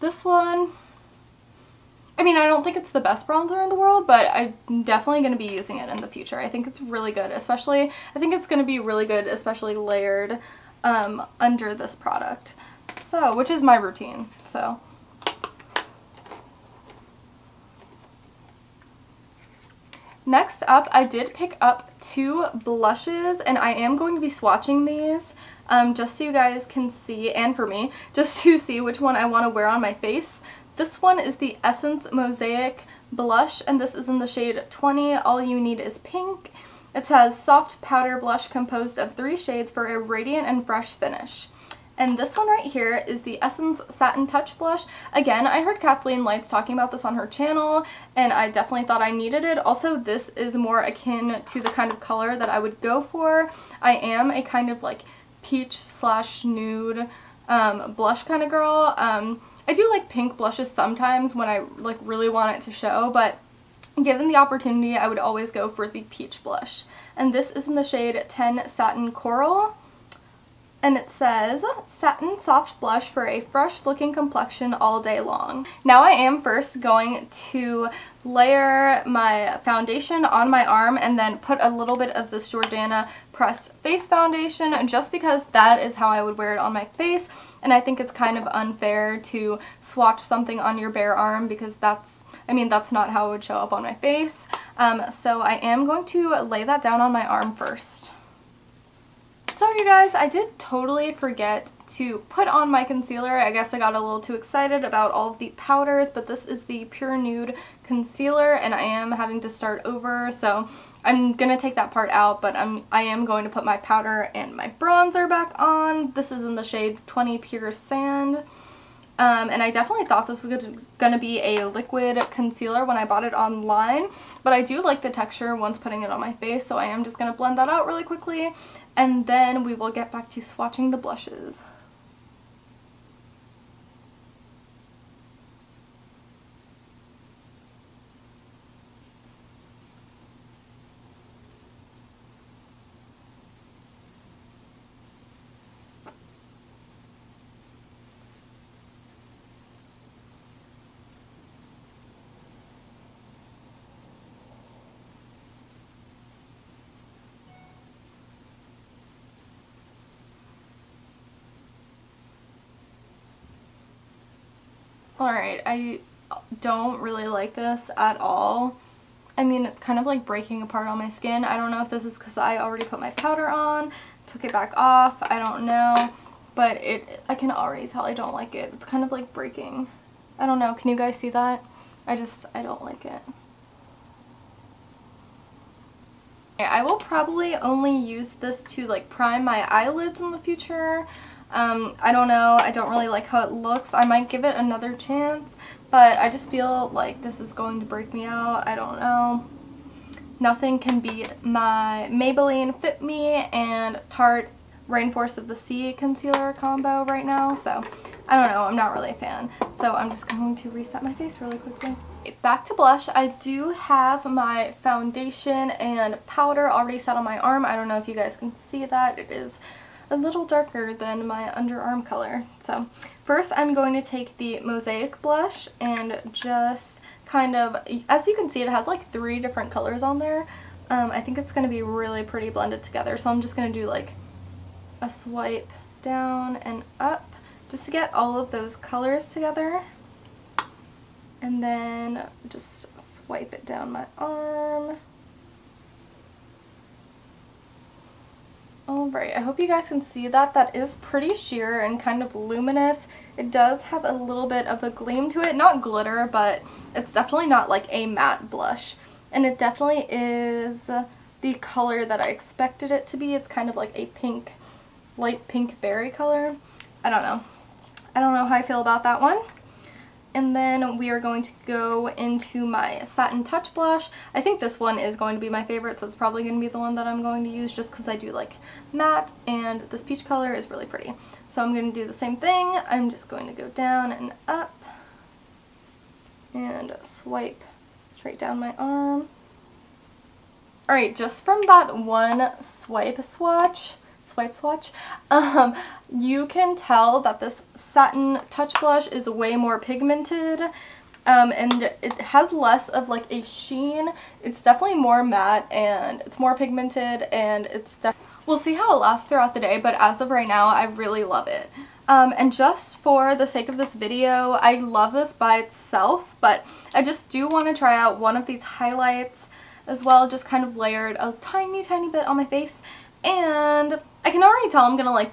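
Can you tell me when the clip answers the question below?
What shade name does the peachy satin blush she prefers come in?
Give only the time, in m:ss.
1:08.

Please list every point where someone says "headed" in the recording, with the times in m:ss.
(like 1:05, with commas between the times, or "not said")
not said.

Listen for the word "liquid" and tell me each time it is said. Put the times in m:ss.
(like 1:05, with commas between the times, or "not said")
2:01.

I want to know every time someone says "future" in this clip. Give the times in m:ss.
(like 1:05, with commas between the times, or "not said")
0:06, 3:10.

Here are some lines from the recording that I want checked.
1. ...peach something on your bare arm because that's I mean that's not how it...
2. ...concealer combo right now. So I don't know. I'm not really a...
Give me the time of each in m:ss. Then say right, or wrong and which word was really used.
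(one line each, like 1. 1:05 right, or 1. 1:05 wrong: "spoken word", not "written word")
1. 1:29 wrong: "swatch", not "peach"
2. 3:25 right.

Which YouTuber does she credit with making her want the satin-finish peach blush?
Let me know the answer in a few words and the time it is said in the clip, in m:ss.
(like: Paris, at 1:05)
Kathleen Lights, at 0:45.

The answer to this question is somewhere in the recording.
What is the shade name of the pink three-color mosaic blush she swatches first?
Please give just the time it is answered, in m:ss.
0:35.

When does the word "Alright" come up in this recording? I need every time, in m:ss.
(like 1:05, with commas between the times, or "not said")
2:45, 4:08, 4:50.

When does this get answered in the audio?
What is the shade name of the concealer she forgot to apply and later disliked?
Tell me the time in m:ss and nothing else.
1:57.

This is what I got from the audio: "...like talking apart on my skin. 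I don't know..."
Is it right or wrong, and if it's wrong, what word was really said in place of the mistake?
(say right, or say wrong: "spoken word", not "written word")
wrong: "breaking", not "talking".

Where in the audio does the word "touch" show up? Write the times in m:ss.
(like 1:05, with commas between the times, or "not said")
0:44, 4:33, 4:58.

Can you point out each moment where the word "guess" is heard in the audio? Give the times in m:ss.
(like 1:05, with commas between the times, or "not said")
1:43.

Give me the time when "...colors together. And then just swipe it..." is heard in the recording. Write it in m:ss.
3:58.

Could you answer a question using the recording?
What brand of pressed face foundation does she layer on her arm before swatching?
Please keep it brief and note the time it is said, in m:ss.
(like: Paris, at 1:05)
Jordana, at 1:22.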